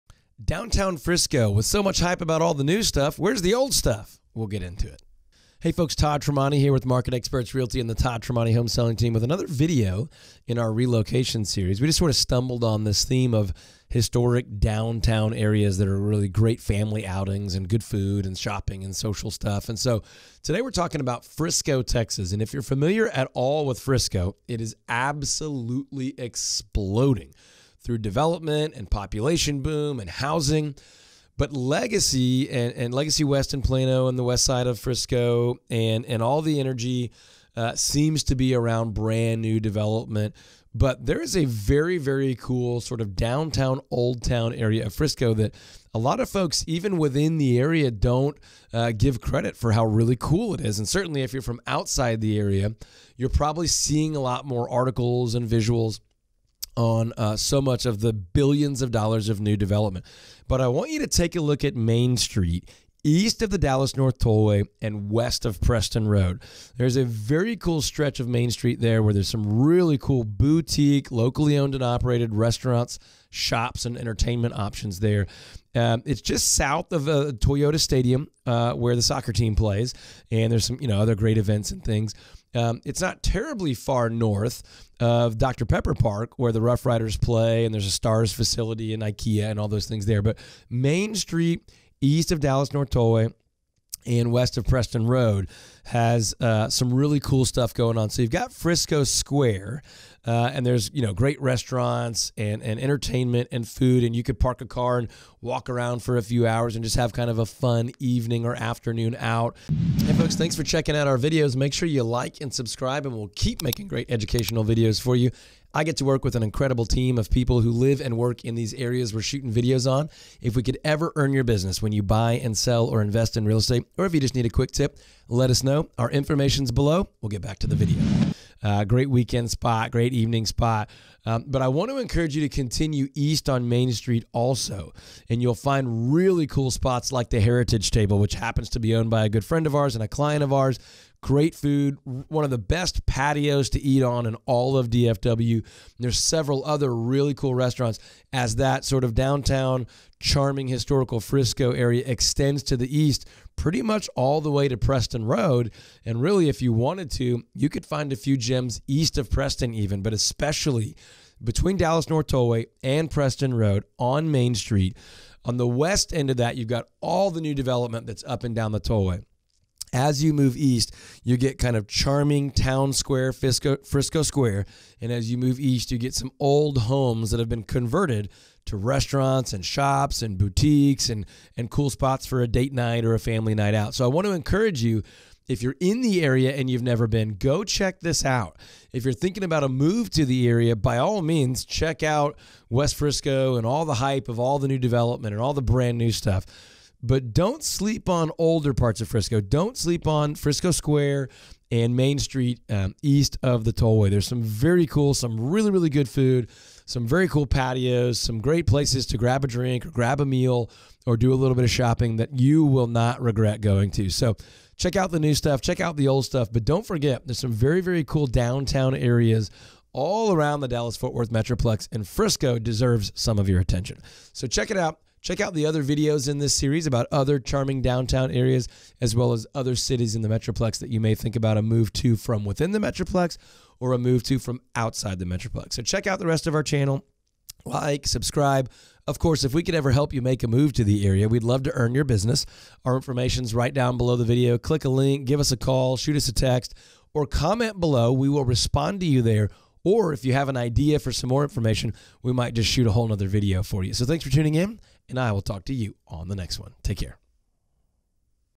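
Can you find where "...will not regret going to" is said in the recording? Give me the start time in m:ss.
3:32.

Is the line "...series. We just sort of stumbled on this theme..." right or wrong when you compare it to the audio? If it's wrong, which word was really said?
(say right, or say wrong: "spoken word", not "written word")
right.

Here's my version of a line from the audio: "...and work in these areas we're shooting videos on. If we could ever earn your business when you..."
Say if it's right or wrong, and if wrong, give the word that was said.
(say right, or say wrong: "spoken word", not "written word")
right.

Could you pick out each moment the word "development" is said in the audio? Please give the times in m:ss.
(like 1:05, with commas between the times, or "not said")
0:27, 0:39, 0:59, 2:47, 3:14.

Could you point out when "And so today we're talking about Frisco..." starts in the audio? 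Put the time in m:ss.
0:19.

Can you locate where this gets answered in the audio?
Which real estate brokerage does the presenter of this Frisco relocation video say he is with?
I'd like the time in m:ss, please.
0:06.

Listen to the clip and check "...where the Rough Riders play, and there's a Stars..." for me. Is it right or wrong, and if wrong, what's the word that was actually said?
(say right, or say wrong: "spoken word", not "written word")
right.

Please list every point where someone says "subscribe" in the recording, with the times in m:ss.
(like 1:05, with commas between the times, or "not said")
1:52, 3:58.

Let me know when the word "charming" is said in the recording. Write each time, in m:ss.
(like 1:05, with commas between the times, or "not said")
2:30, 2:51, 3:47.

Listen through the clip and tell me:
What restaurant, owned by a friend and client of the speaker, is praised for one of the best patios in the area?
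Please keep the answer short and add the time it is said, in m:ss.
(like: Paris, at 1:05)
Heritage Table, at 2:17.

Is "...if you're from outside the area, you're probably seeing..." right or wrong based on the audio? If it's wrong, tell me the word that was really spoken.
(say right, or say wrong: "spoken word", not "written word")
right.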